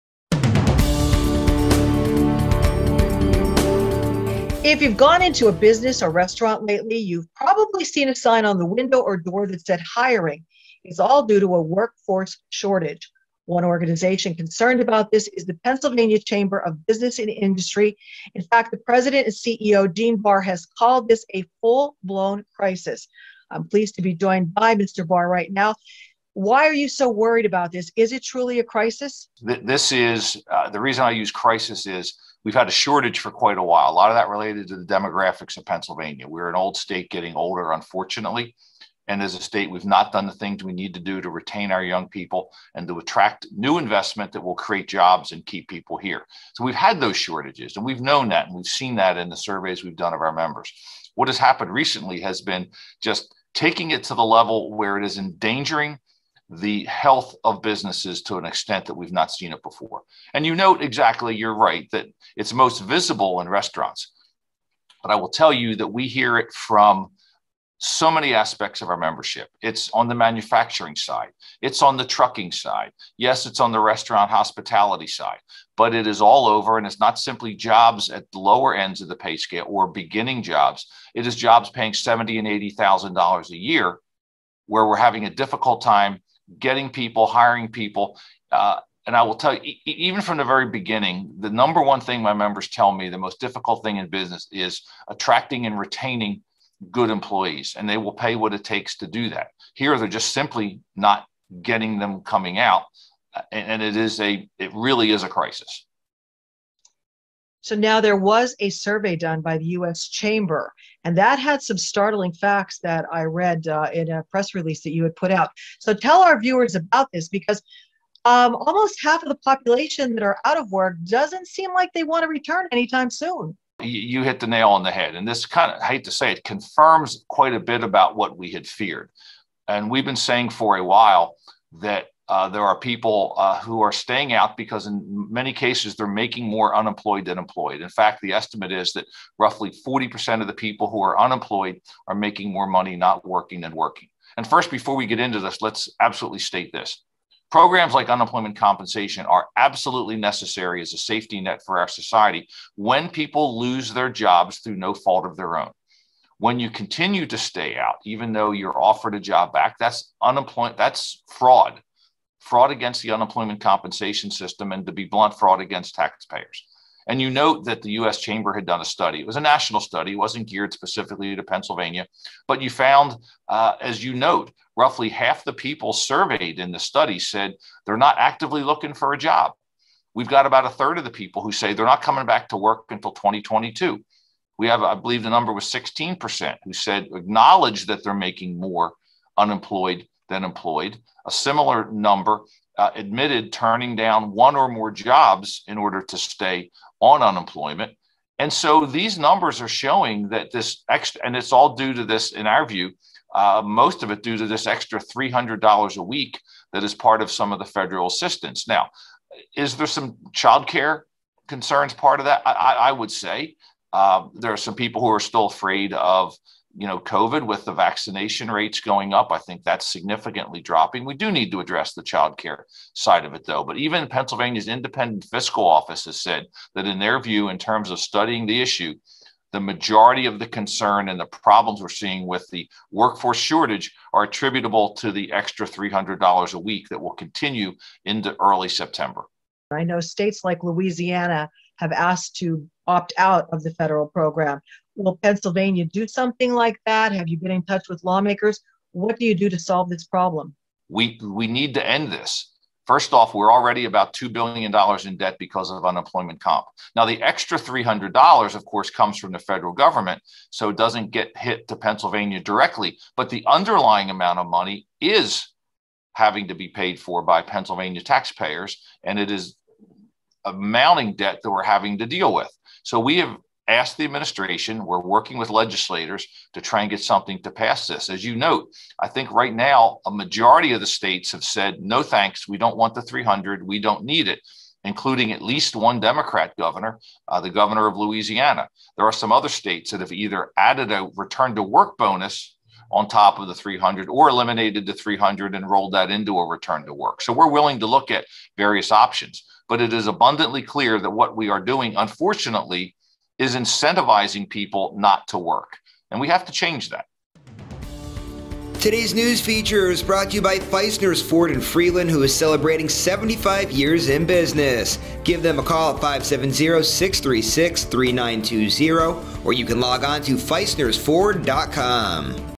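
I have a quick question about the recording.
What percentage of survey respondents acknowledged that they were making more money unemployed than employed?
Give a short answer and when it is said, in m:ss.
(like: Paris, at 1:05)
16%, at 3:05.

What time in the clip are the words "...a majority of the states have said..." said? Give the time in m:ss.
4:40.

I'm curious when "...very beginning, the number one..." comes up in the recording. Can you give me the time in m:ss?
1:30.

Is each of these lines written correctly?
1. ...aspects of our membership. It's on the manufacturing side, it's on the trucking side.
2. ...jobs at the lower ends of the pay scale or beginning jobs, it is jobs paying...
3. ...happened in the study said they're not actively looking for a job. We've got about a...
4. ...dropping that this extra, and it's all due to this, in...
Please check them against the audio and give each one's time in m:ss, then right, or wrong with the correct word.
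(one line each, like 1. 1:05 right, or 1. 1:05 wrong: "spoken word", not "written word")
1. 1:08 right
2. 1:17 right
3. 2:55 wrong: "surveyed", not "happened"
4. 3:19 wrong: "showing", not "dropping".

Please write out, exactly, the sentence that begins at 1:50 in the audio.
Chamber, and that had some startling facts that I read uh, in a press release that you had put out.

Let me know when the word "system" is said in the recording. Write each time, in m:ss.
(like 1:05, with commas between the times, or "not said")
2:44.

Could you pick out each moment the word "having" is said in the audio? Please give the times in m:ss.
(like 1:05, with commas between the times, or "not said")
1:24, 4:26, 4:31.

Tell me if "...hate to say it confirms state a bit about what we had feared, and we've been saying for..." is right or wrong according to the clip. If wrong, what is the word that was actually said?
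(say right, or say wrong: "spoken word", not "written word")
wrong: "quite", not "state".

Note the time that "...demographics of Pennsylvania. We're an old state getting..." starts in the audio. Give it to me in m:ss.
0:34.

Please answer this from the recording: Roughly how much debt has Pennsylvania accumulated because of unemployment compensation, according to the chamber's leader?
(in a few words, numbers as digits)
$2 billion.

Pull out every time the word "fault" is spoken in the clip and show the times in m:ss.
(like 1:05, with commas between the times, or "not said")
2:34.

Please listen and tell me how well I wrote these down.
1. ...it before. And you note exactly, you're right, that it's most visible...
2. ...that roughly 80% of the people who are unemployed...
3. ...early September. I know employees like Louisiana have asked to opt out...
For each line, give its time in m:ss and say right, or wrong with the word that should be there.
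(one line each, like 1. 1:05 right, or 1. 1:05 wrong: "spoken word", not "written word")
1. 0:59 right
2. 2:18 wrong: "40", not "80"
3. 3:58 wrong: "states", not "employees".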